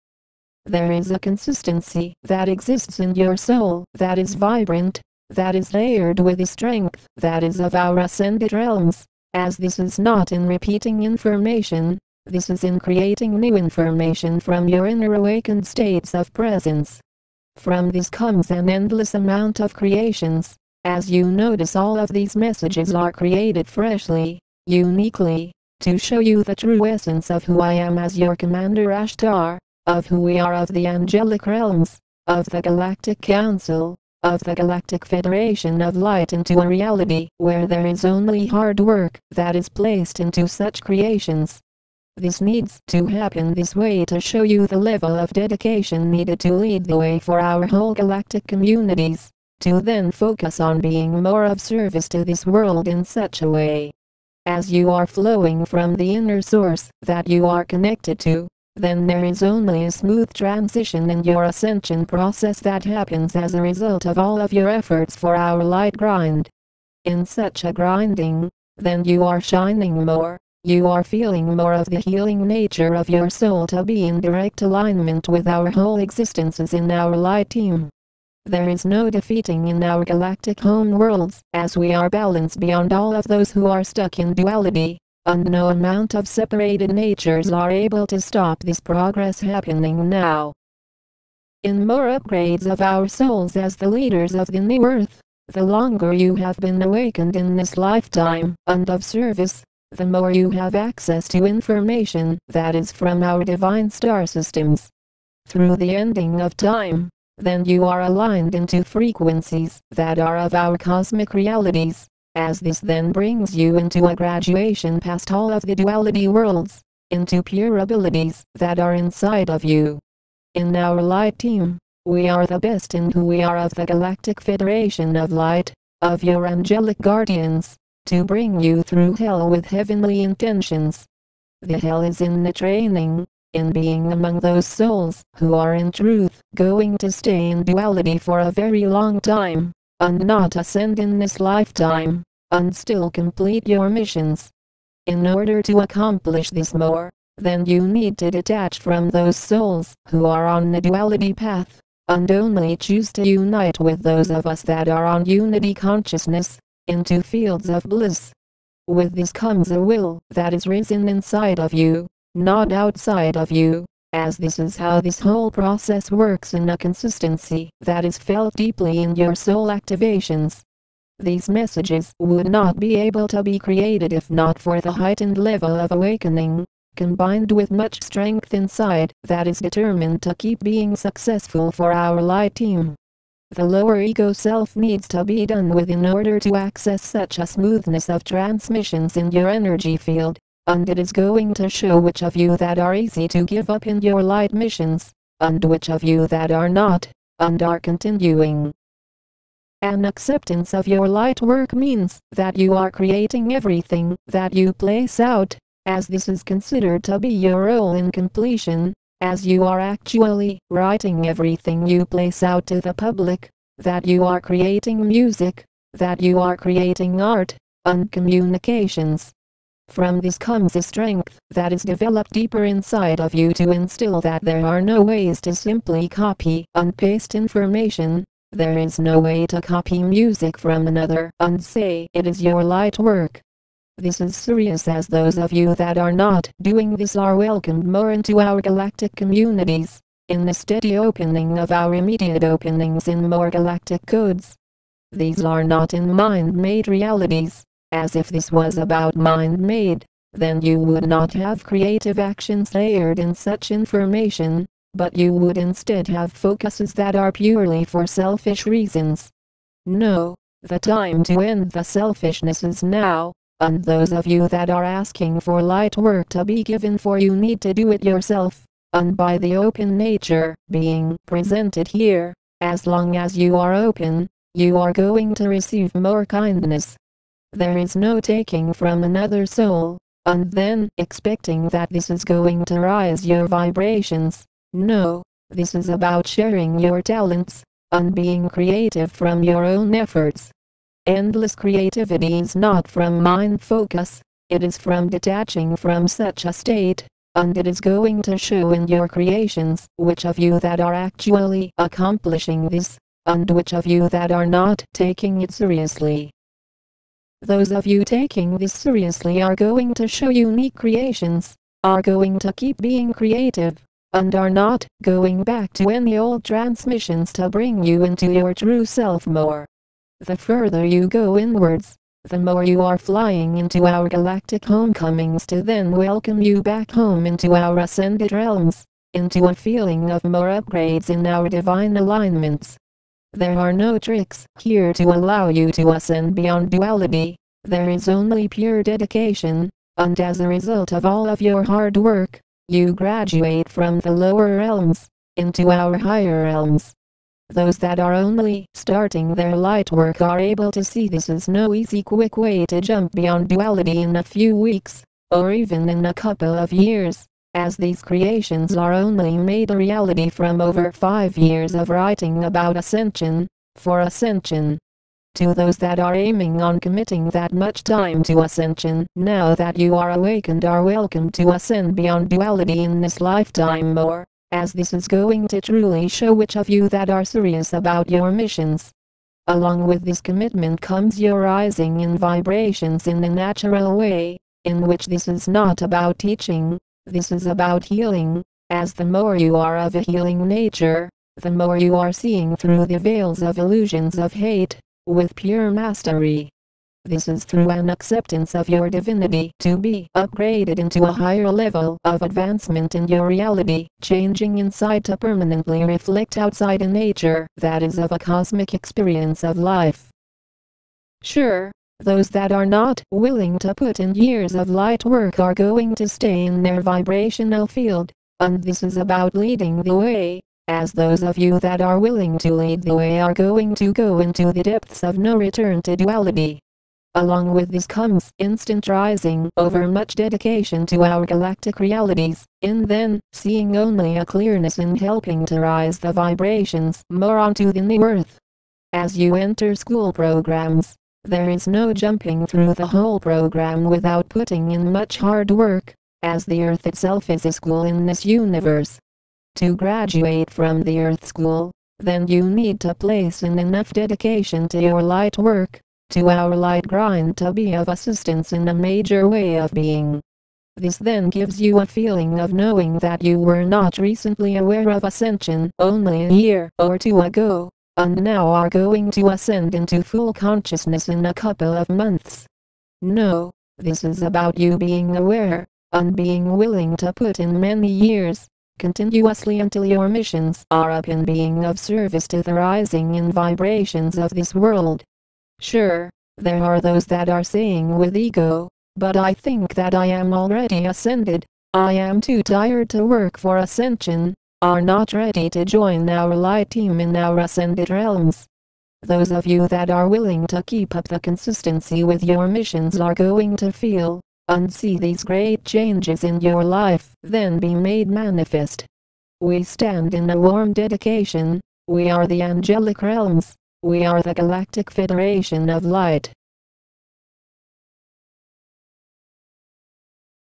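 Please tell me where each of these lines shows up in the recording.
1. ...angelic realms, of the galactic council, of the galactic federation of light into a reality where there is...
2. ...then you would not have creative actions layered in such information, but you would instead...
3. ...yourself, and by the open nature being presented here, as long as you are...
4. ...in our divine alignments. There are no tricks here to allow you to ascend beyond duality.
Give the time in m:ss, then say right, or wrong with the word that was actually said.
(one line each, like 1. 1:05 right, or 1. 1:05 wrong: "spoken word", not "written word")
1. 0:30 right
2. 4:10 right
3. 4:28 right
4. 5:31 right.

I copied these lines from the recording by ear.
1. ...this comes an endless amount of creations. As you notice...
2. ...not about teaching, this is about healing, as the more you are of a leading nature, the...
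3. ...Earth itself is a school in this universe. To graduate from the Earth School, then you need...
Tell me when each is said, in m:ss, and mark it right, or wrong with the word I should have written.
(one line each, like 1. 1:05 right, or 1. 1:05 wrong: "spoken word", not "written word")
1. 0:17 right
2. 6:25 wrong: "healing", not "leading"
3. 7:26 right.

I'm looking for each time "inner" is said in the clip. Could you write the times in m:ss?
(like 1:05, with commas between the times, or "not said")
0:14, 0:56.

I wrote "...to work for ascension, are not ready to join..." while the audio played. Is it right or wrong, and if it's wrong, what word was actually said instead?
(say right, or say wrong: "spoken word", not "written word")
right.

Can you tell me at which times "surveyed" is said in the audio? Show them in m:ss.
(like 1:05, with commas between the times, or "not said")
not said.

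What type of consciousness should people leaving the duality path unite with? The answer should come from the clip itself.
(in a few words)
unity consciousness.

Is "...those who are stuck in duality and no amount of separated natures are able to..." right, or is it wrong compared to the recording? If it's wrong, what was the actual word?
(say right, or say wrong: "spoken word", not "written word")
right.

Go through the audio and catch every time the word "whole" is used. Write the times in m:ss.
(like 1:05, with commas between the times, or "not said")
0:47, 1:15, 2:45, 7:22.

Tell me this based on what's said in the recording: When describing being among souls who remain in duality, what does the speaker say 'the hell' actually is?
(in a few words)
the training.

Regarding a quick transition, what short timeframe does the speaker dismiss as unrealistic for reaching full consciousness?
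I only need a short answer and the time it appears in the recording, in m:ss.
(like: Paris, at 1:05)
a couple of months, at 7:51.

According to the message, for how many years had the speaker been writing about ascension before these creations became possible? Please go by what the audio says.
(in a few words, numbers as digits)
over five years.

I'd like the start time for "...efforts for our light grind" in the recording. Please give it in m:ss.
1:04.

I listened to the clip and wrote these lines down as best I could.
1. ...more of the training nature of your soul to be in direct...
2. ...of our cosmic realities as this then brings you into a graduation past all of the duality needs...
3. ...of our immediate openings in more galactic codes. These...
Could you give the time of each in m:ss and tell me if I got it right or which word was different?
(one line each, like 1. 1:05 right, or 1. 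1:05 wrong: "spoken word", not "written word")
1. 1:11 wrong: "healing", not "training"
2. 1:50 wrong: "worlds", not "needs"
3. 4:01 right.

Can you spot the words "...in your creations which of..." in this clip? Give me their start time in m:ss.
4:58.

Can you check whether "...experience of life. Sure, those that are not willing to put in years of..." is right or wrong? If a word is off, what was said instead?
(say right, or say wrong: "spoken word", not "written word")
right.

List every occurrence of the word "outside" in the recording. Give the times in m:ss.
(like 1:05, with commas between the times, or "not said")
2:42, 6:46.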